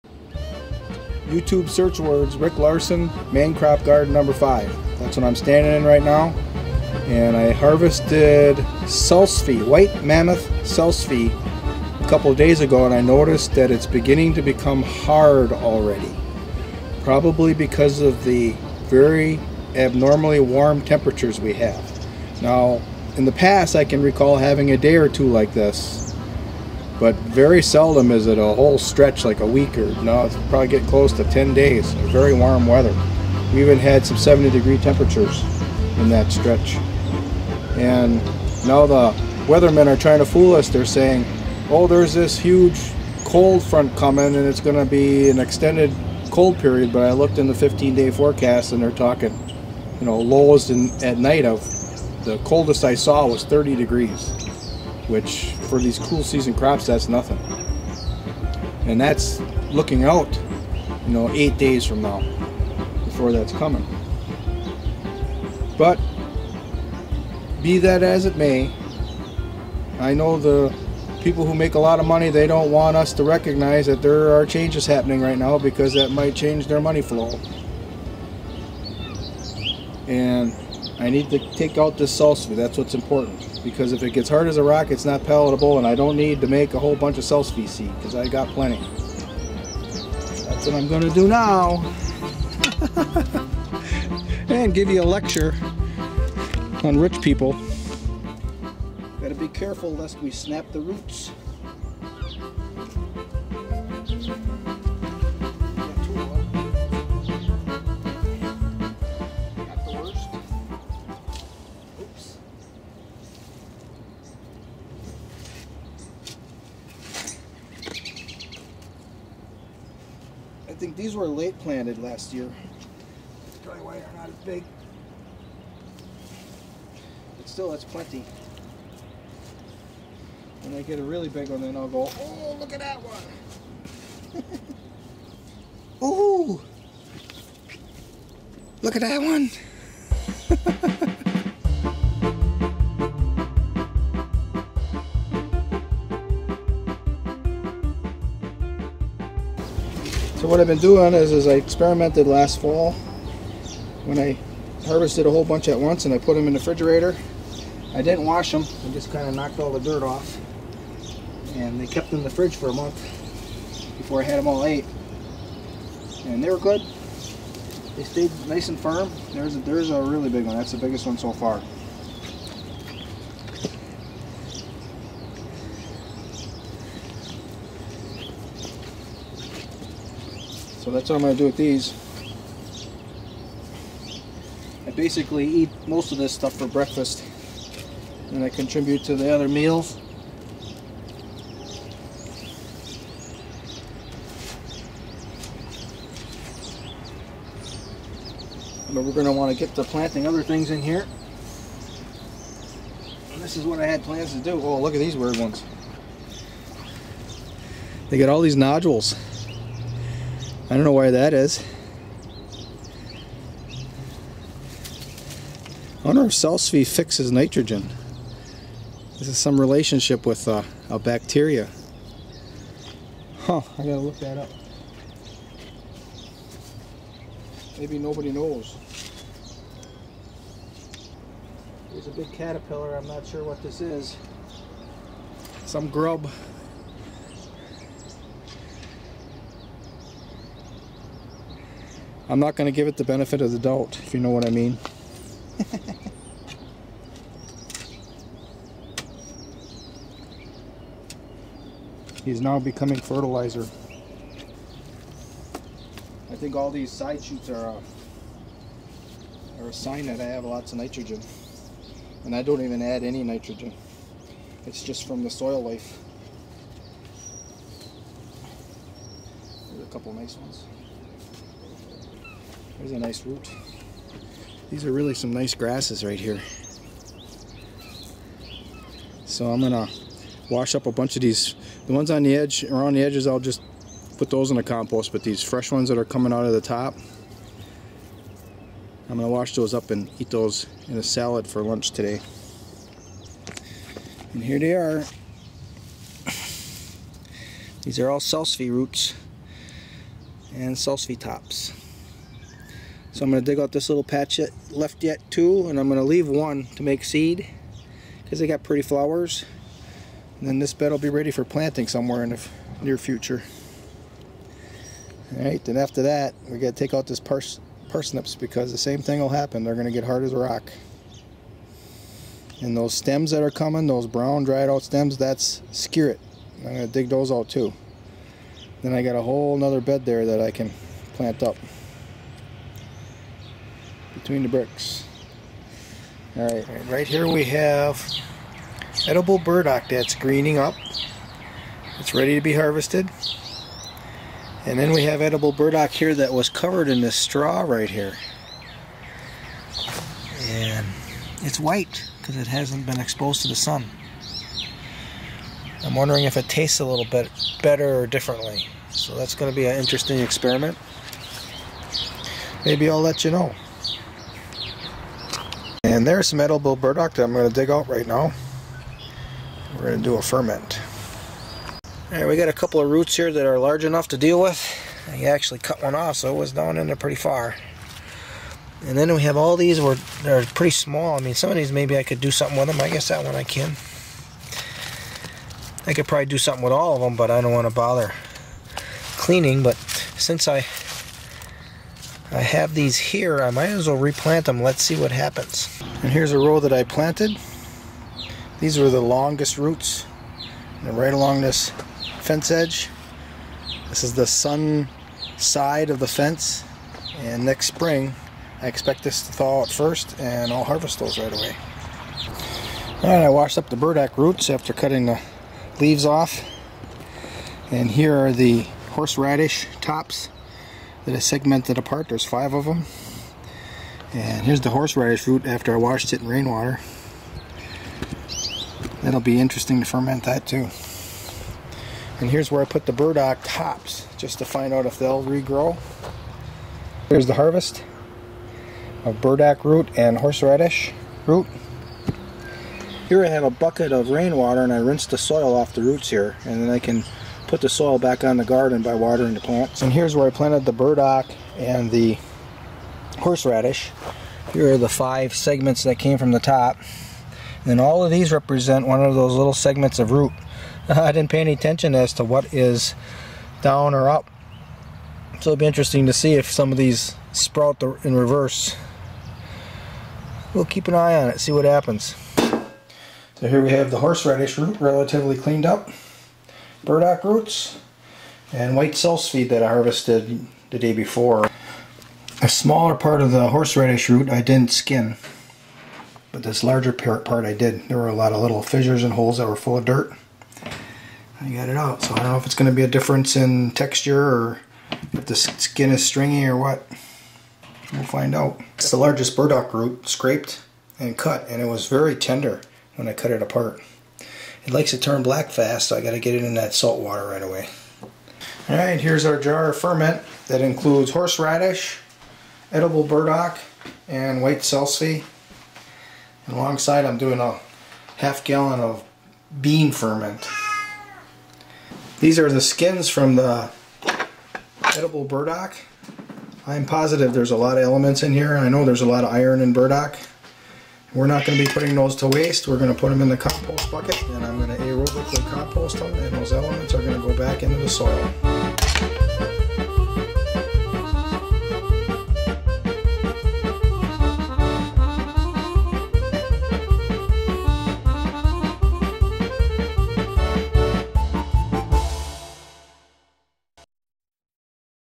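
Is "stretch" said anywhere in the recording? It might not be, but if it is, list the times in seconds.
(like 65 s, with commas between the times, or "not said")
28 s, 36 s.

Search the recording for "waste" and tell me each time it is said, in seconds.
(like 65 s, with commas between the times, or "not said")
532 s.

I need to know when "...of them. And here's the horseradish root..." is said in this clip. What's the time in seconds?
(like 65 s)
422 s.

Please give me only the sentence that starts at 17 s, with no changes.
Probably because of the very abnormally warm temperatures we have.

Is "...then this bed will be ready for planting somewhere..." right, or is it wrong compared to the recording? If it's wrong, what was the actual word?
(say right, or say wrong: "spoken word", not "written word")
right.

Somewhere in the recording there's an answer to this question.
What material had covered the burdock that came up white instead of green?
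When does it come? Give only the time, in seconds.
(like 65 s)
347 s.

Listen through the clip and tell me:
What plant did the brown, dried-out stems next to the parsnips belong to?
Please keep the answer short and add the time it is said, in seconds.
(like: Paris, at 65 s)
Skirret, at 325 s.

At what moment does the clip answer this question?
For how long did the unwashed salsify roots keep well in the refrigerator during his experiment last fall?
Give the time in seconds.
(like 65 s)
162 s.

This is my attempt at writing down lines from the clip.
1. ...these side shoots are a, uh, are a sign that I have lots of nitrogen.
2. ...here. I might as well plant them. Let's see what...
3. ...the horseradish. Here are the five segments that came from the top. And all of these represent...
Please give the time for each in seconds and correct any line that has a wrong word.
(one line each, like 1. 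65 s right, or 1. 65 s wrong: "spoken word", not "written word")
1. 256 s right
2. 392 s wrong: "replant", not "plant"
3. 451 s right.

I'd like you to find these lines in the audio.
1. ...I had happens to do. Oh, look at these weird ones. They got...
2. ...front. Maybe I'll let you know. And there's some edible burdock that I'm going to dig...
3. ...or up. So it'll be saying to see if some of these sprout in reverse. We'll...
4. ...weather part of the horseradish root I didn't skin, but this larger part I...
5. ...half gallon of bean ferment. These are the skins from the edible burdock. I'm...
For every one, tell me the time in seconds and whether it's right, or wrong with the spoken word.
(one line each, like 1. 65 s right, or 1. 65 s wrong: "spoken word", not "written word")
1. 203 s wrong: "plans", not "happens"
2. 360 s wrong: "experiment", not "front"
3. 463 s wrong: "interesting", not "saying"
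4. 482 s wrong: "smaller", not "weather"
5. 518 s right.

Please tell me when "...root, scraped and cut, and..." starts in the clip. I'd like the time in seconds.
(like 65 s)
499 s.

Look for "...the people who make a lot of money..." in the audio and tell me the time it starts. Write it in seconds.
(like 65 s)
70 s.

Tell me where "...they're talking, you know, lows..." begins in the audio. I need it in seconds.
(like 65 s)
48 s.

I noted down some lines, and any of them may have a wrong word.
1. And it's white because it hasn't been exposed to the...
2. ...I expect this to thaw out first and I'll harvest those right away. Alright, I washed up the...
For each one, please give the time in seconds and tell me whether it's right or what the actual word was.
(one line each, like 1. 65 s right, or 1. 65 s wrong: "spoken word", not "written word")
1. 350 s right
2. 408 s right.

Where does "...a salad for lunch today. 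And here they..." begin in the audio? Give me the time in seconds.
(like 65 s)
290 s.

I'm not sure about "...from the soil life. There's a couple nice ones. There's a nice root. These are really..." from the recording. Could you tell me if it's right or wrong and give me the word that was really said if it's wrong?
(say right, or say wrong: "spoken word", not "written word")
right.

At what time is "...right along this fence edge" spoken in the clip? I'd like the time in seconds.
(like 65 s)
400 s.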